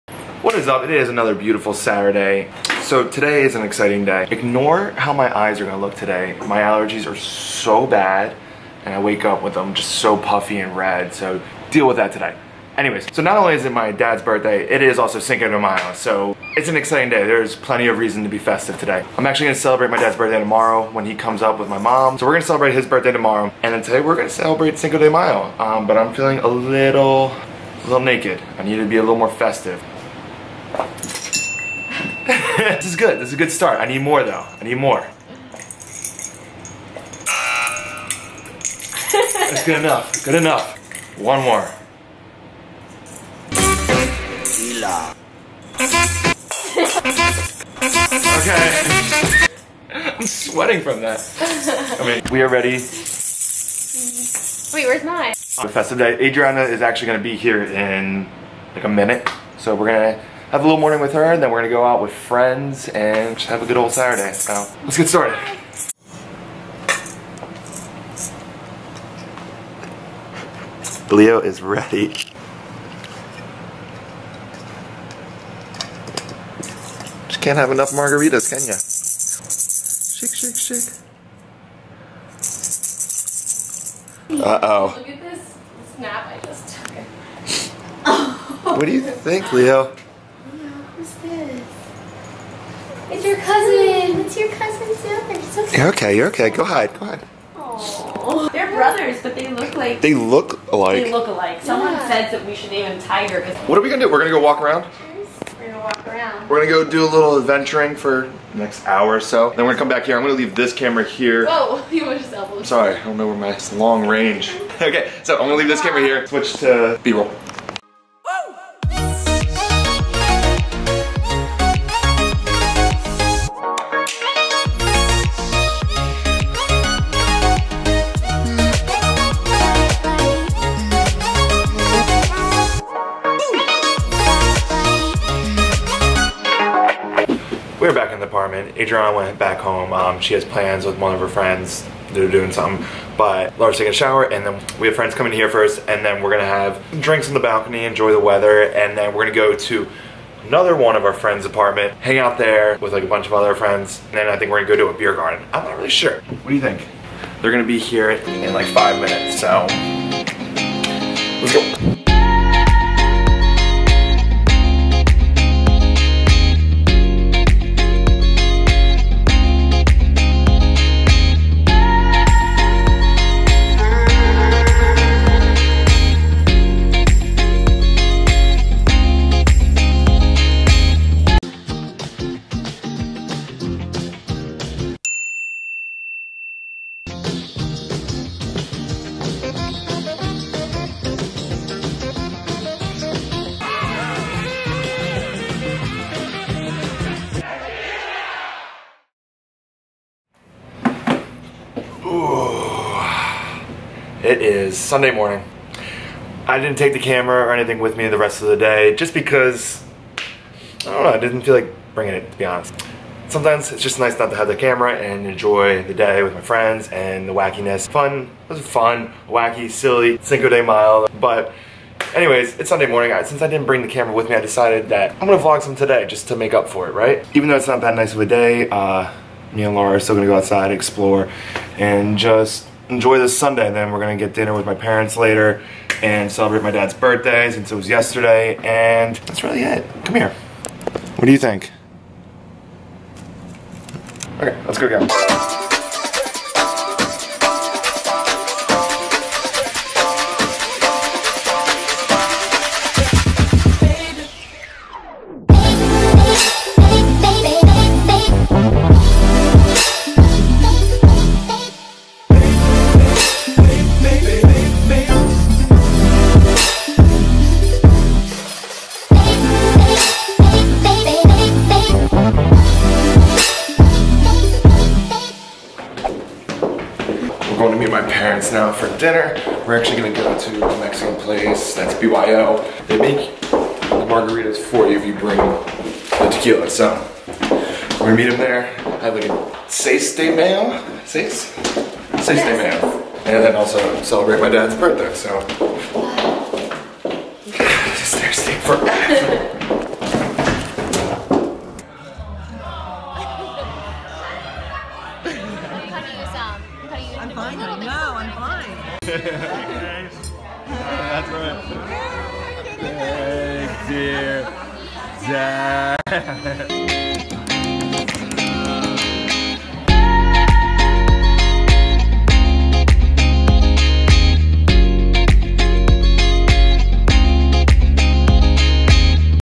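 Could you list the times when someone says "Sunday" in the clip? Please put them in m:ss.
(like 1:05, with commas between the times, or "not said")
3:24, 3:42, 3:53.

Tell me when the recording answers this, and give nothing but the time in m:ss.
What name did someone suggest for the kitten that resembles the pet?
1:43.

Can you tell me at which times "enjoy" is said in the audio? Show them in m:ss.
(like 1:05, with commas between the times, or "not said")
2:27, 3:35, 3:52.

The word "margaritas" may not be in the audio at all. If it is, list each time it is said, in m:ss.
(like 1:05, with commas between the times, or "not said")
1:17, 4:44.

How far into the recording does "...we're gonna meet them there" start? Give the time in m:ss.
4:47.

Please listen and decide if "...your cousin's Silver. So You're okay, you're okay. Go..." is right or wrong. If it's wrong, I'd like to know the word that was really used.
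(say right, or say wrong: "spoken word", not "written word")
right.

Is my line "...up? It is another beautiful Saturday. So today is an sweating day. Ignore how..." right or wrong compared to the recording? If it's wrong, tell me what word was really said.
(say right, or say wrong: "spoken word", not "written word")
wrong: "exciting", not "sweating".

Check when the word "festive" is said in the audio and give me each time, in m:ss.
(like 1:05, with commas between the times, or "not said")
0:18, 0:29, 0:55.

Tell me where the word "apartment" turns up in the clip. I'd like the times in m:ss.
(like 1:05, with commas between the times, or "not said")
2:18, 2:31.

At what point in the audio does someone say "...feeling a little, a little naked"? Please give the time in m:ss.
0:26.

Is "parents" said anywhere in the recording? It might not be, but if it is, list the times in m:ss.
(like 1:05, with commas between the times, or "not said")
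3:54, 4:38.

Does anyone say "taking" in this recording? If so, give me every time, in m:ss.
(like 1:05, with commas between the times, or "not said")
2:23.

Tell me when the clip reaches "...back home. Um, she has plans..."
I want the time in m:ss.
2:19.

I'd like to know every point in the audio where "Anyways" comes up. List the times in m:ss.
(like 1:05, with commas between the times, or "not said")
0:12, 3:42.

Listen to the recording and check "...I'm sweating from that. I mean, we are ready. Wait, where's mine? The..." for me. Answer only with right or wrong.
right.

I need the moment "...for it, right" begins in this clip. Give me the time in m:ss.
3:46.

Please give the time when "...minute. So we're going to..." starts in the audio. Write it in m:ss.
0:58.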